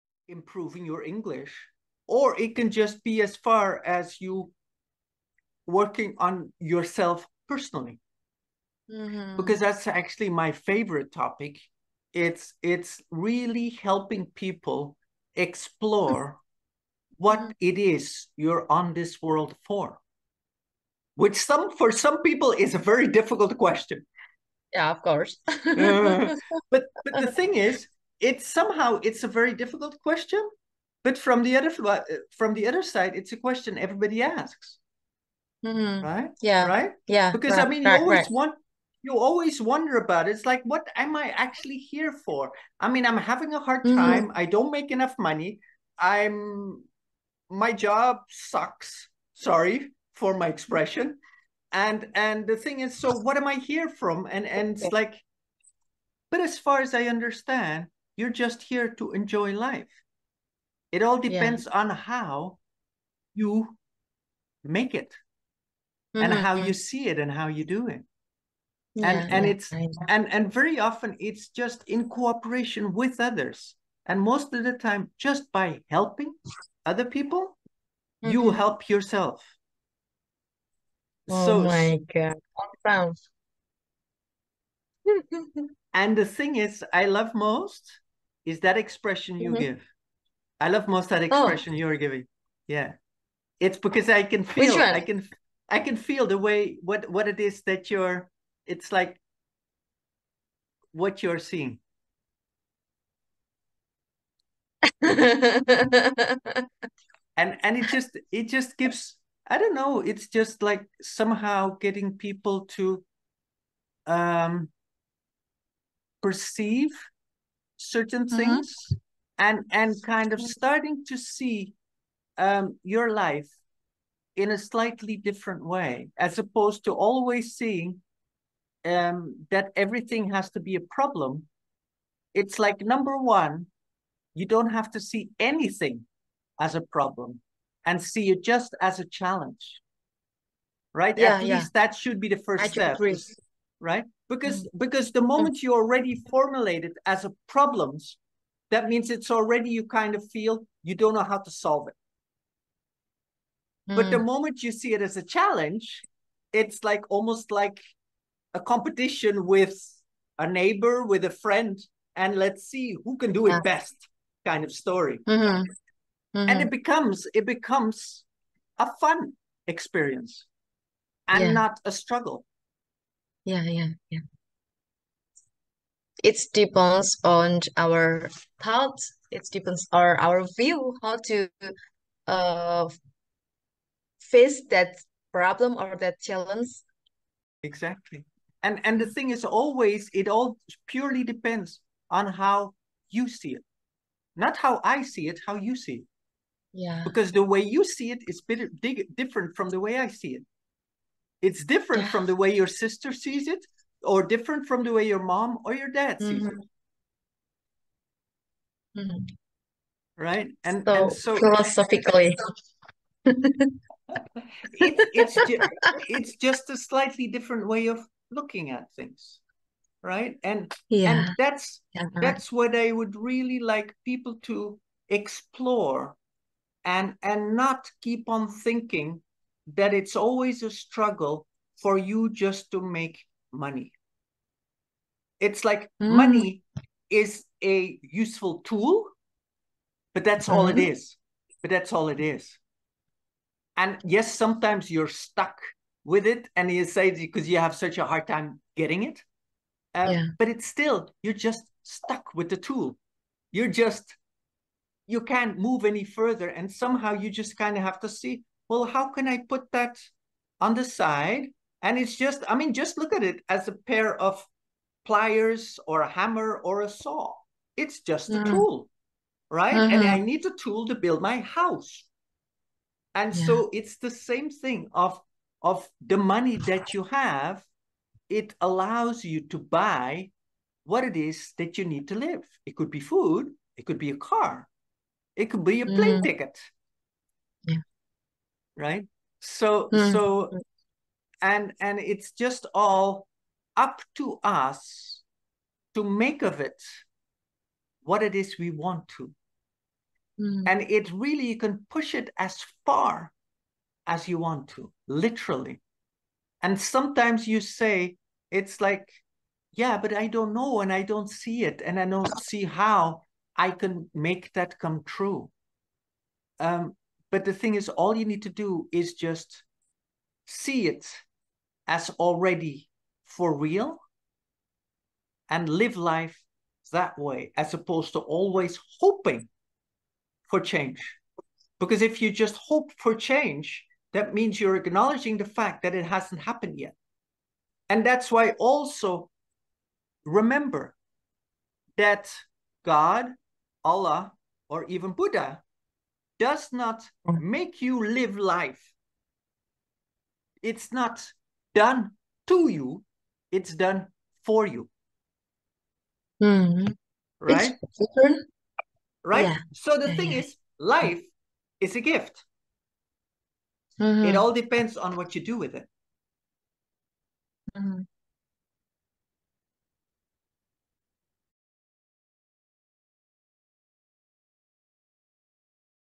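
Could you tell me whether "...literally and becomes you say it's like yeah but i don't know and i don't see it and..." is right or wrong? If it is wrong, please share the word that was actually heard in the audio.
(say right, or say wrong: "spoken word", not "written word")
wrong: "sometimes", not "becomes".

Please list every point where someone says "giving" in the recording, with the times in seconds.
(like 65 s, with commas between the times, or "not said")
91 s.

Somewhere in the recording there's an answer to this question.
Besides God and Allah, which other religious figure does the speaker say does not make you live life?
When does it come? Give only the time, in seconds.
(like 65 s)
345 s.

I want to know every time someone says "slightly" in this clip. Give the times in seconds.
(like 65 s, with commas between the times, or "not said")
124 s, 216 s.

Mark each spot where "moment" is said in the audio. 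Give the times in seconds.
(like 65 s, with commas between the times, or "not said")
145 s, 154 s.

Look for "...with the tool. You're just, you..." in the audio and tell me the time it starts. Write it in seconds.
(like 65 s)
252 s.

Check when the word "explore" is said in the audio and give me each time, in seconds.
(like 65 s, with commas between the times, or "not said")
15 s, 225 s.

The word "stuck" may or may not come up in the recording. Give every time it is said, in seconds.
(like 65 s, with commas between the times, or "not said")
245 s, 251 s.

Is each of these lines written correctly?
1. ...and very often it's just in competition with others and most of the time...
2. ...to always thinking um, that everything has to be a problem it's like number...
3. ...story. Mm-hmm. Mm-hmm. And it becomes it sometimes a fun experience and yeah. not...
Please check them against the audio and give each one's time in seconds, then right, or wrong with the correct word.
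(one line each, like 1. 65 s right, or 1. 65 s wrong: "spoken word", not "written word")
1. 70 s wrong: "cooperation", not "competition"
2. 126 s wrong: "seeing", not "thinking"
3. 164 s wrong: "becomes", not "sometimes".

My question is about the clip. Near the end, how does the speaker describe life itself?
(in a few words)
a gift.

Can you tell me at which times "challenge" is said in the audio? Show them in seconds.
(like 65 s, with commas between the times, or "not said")
139 s, 155 s, 186 s.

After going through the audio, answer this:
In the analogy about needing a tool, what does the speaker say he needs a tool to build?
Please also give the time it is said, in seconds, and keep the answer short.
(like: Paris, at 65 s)
my house, at 271 s.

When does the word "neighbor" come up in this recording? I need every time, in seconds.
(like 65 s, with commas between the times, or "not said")
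160 s.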